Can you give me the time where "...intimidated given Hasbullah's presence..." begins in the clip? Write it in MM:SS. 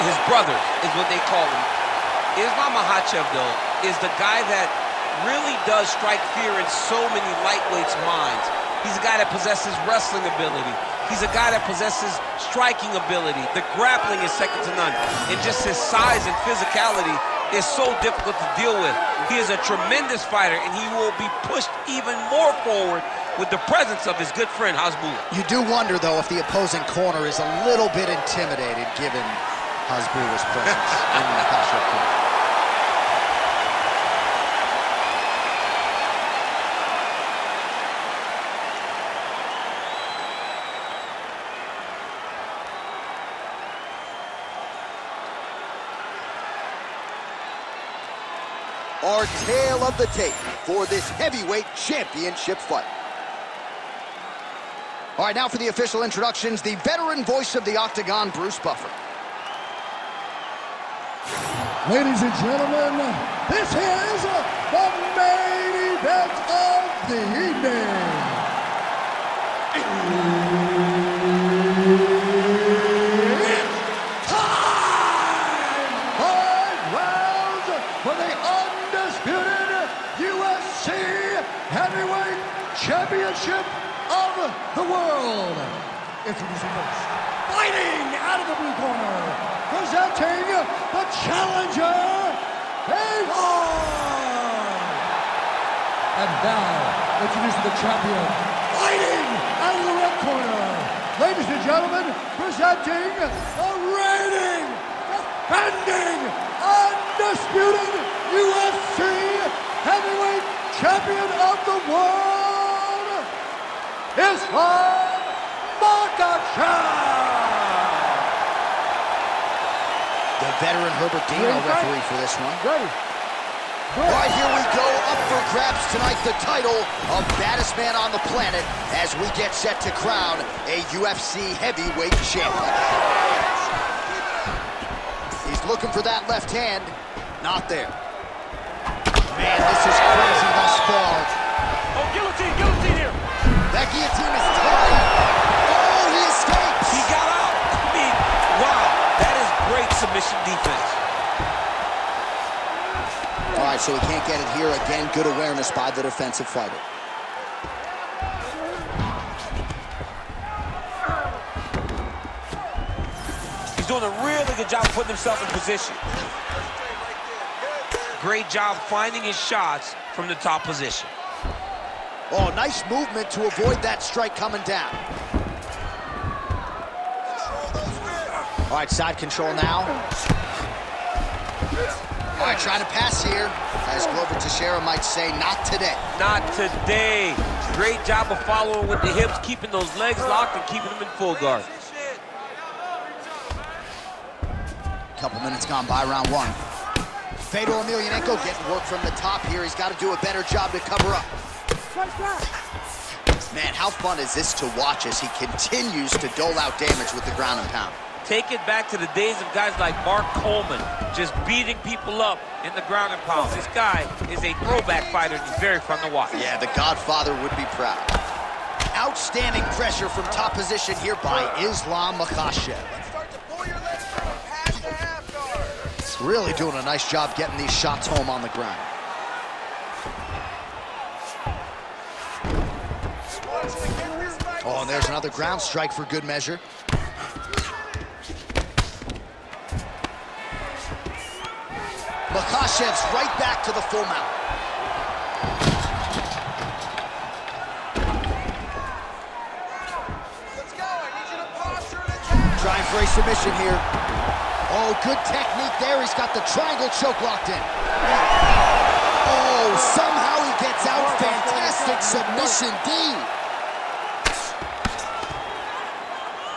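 00:28.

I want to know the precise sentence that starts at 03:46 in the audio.
Really doing a nice job getting these shots home on the ground.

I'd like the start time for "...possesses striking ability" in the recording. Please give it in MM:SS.
00:11.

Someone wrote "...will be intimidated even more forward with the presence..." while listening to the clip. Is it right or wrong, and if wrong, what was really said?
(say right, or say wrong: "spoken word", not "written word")
wrong: "pushed", not "intimidated".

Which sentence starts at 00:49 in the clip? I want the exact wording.
our tale of the tape for this heavyweight championship fight.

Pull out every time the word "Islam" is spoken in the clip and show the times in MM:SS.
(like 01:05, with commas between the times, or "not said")
00:02, 03:41.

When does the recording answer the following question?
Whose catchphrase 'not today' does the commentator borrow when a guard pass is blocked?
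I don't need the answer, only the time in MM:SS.
03:04.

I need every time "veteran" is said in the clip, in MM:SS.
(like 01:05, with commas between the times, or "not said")
00:56, 02:00.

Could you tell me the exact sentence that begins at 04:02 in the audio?
Makhachev's right back to the full mount.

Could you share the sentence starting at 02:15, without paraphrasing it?
He's looking for that left hand, not there.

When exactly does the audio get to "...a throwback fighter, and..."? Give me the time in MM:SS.
03:34.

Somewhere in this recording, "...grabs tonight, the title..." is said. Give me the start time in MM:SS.
02:05.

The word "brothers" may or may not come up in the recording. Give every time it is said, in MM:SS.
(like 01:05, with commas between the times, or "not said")
00:00.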